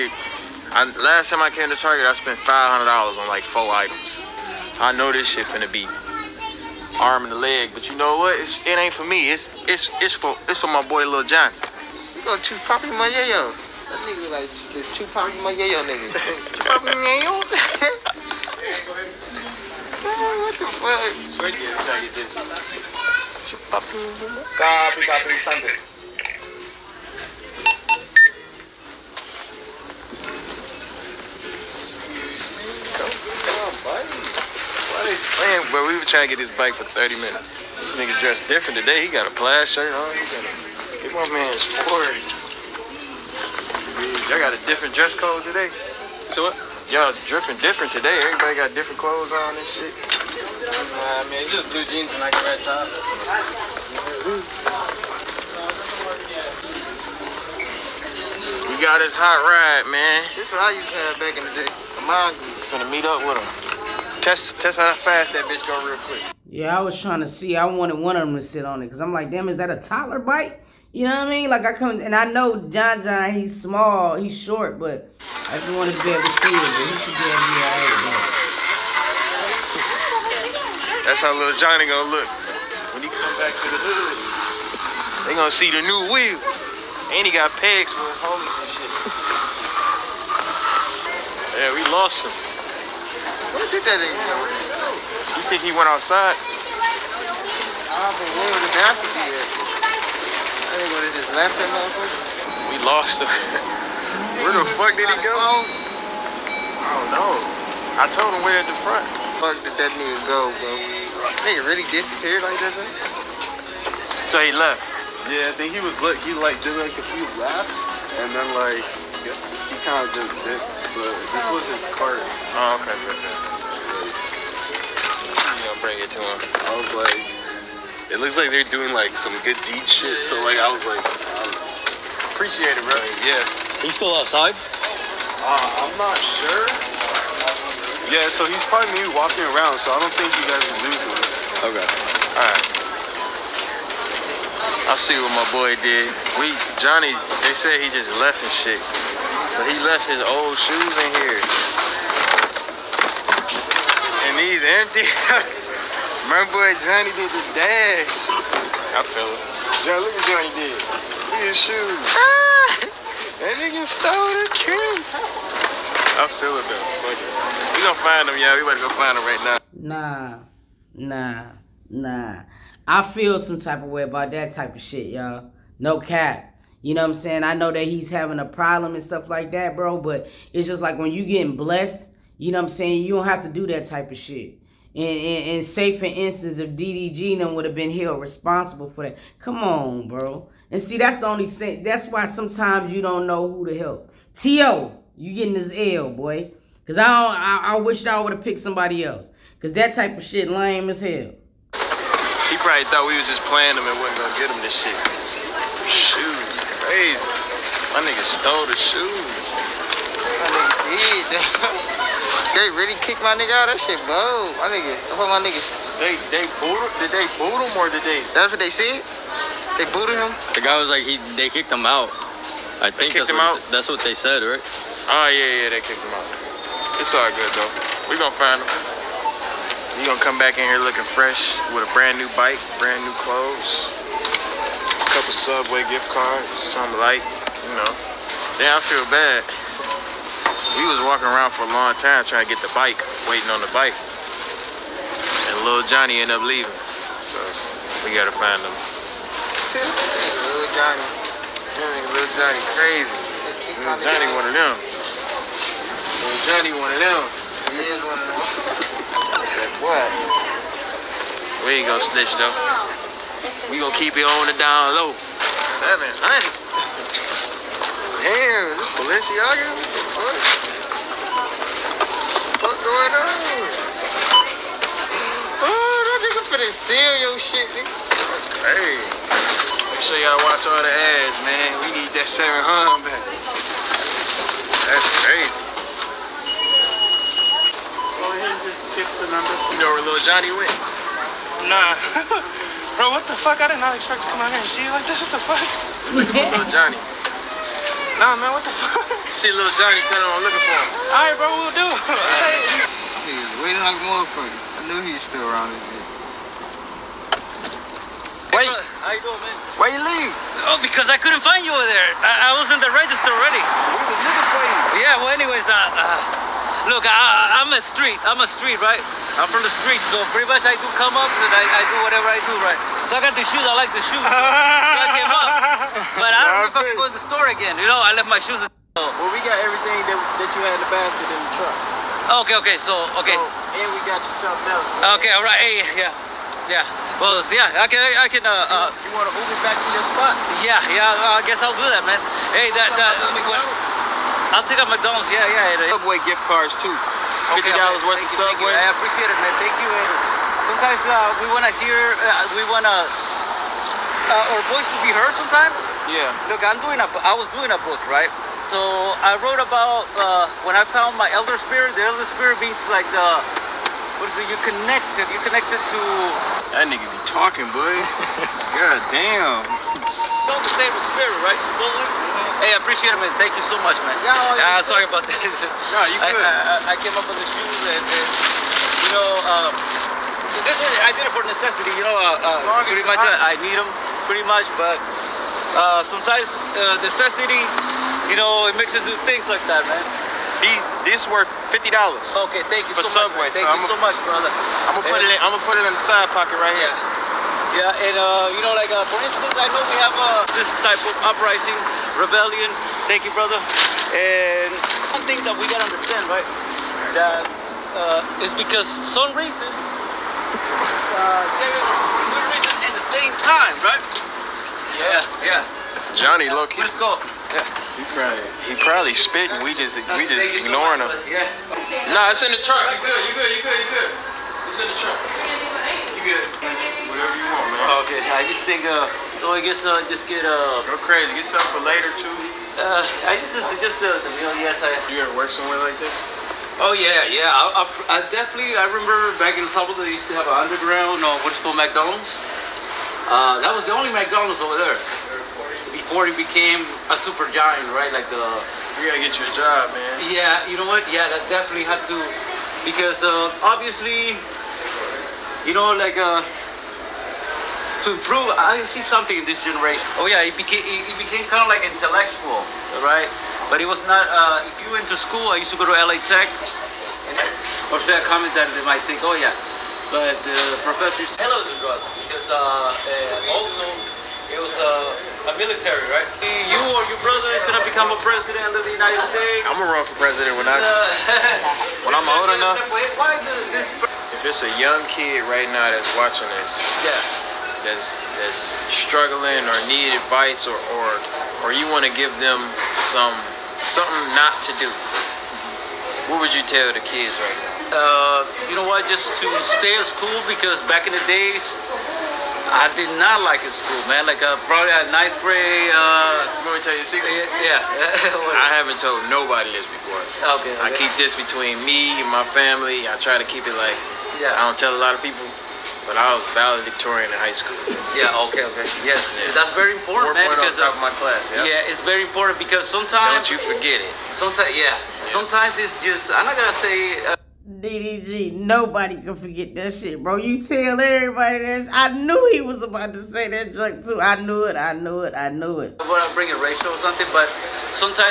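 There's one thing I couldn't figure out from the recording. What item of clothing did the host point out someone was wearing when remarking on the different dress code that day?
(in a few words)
Plaid shirt.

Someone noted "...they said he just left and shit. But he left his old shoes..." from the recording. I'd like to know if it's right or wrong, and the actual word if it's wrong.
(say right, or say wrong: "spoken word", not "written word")
right.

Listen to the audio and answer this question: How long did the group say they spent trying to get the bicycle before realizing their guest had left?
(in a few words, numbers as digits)
30 minutes.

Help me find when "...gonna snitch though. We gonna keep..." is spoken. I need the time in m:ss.
4:21.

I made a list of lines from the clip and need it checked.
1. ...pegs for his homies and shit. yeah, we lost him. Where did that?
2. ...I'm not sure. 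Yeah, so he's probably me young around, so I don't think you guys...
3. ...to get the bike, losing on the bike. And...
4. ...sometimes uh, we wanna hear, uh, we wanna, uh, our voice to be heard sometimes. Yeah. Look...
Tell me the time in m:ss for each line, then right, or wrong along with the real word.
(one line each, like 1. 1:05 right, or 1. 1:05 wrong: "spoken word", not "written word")
1. 1:27 right
2. 2:15 wrong: "walking", not "young"
3. 4:02 wrong: "waiting", not "losing"
4. 5:50 right.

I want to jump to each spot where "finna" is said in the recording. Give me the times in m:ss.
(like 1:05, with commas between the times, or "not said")
0:05, 4:36.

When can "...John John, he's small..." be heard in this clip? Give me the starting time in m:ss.
1:12.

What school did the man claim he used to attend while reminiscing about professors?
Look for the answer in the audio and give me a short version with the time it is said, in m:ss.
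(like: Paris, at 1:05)
LA Tech, at 7:45.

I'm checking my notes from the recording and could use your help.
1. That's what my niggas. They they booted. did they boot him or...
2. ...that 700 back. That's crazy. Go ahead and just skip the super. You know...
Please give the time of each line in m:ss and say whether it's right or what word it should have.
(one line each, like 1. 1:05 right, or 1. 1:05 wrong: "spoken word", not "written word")
1. 3:35 right
2. 4:42 wrong: "number", not "super".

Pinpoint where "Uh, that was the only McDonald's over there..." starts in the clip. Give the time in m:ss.
7:23.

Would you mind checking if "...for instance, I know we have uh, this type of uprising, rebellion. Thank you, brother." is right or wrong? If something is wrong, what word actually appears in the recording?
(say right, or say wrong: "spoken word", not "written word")
right.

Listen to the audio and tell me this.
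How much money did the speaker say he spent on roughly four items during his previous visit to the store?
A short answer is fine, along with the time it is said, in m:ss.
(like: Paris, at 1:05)
$500, at 0:02.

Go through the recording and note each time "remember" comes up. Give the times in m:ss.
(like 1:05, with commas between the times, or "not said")
7:18.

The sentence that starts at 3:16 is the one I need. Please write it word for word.
Because I, I, I wish I would have picked somebody else.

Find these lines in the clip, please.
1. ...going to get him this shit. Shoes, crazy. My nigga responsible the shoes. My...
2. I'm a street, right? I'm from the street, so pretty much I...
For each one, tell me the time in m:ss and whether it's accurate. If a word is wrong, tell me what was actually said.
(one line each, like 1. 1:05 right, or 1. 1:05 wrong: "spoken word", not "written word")
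1. 3:24 wrong: "stole", not "responsible"
2. 5:18 right.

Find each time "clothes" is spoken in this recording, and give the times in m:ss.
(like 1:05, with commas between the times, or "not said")
0:48, 3:53.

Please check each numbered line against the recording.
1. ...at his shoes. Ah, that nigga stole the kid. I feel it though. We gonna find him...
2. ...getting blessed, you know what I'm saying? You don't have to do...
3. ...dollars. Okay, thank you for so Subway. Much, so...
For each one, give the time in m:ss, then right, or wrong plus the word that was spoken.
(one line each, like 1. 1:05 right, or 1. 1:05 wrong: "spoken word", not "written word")
1. 2:41 right
2. 3:01 right
3. 6:31 right.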